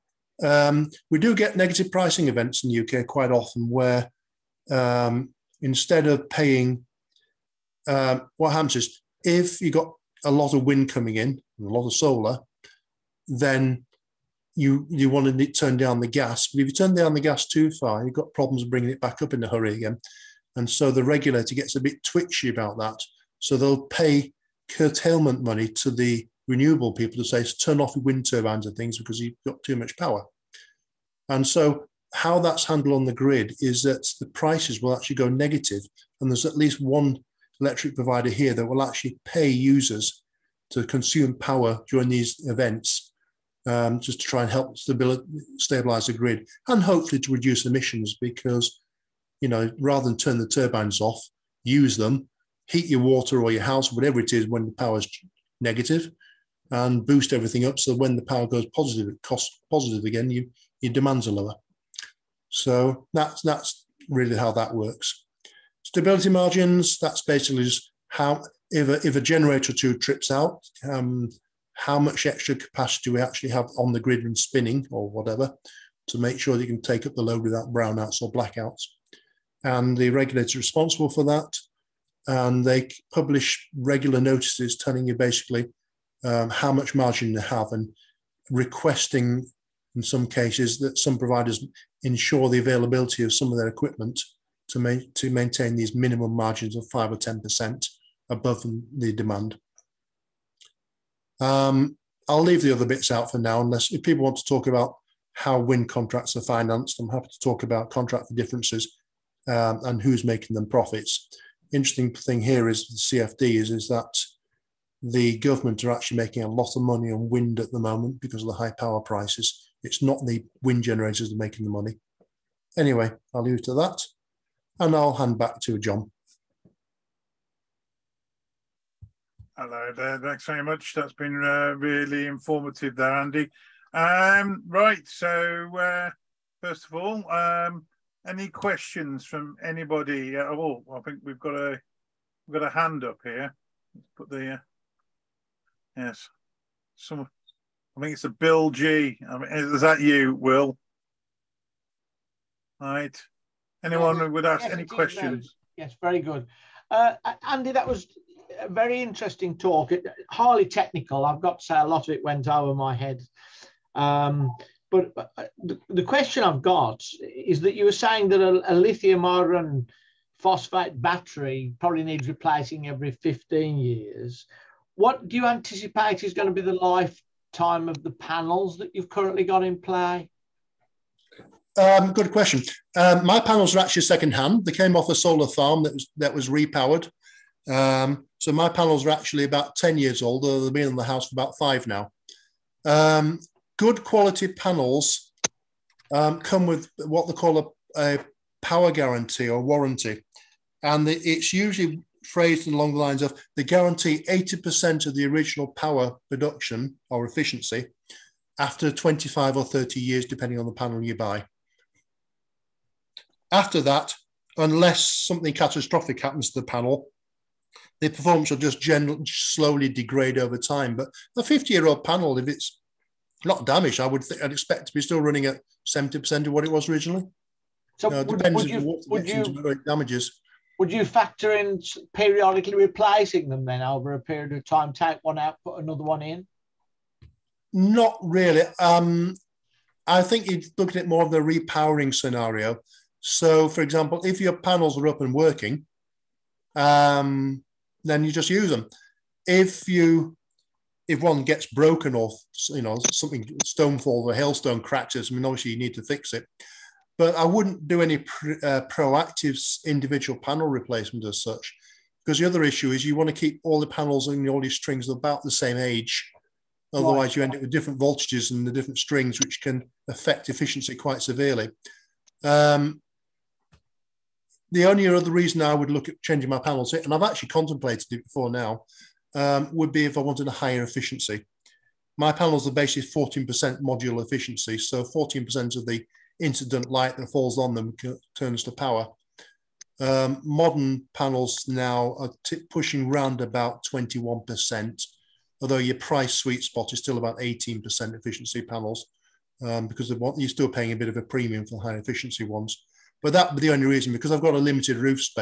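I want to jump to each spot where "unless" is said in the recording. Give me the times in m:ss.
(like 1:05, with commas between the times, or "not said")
1:43, 3:34.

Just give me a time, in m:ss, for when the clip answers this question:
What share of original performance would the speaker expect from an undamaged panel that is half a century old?
3:45.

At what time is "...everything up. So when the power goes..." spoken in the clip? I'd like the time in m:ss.
0:57.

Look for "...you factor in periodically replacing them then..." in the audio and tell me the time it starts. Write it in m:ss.
3:50.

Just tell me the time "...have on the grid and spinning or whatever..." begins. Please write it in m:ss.
1:13.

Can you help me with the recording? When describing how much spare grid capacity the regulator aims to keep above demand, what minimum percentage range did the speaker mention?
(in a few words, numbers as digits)
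5 or 10%.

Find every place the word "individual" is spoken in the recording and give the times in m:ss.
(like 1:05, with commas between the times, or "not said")
4:19.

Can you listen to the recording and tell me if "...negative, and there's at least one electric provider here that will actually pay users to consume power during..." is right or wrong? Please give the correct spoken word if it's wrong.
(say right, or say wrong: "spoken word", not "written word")
right.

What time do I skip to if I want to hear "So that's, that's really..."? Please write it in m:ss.
1:02.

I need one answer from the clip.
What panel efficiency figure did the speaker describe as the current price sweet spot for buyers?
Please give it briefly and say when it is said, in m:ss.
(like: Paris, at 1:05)
18%, at 4:57.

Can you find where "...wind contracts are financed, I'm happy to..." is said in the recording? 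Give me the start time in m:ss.
1:45.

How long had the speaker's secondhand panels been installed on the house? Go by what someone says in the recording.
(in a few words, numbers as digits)
about 5 years.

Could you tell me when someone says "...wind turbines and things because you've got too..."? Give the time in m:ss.
0:28.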